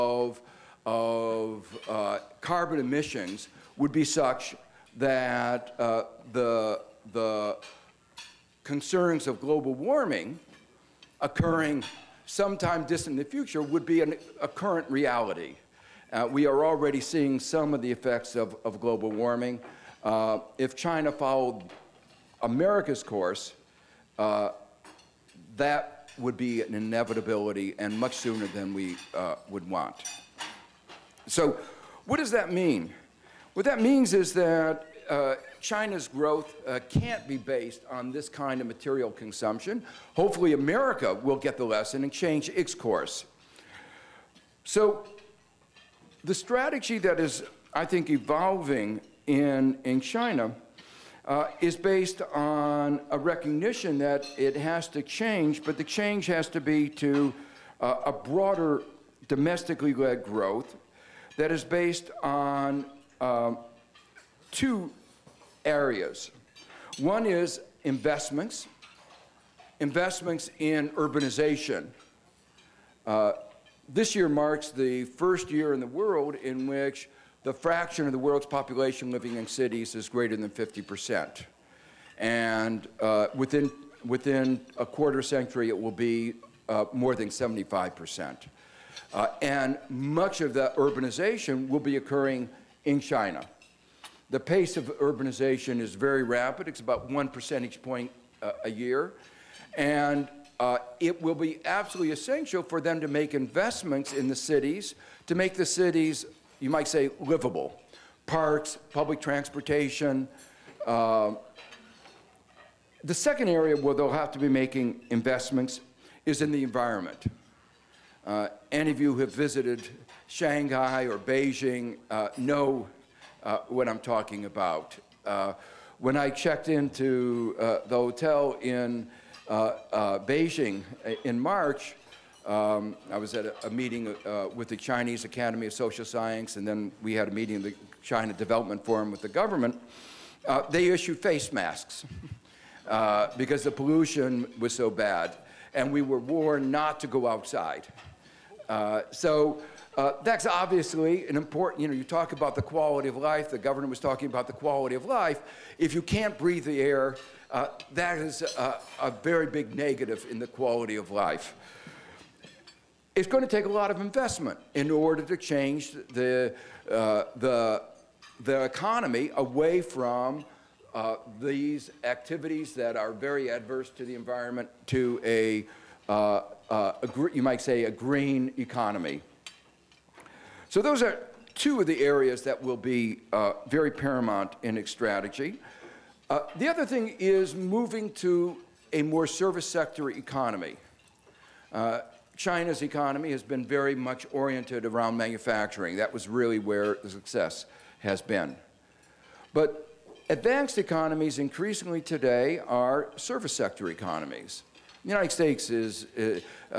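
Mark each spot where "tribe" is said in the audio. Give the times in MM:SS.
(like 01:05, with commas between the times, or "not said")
not said.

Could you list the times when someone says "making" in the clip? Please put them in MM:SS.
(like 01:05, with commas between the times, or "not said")
01:54.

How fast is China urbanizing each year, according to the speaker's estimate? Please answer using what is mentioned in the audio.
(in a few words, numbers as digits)
1 percentage point.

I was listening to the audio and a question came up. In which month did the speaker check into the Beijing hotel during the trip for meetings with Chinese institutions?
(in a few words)
March.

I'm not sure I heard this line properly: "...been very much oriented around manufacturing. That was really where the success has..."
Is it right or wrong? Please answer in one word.
right.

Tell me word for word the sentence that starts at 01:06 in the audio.
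One is investments, investments in urbanization.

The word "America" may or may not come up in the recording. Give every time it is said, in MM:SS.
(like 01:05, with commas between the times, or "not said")
00:22, 00:40.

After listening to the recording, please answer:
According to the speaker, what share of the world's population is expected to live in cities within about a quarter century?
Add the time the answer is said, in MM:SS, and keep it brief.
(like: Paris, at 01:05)
more than 75%, at 01:26.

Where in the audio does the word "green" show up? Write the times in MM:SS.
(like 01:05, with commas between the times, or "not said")
02:57.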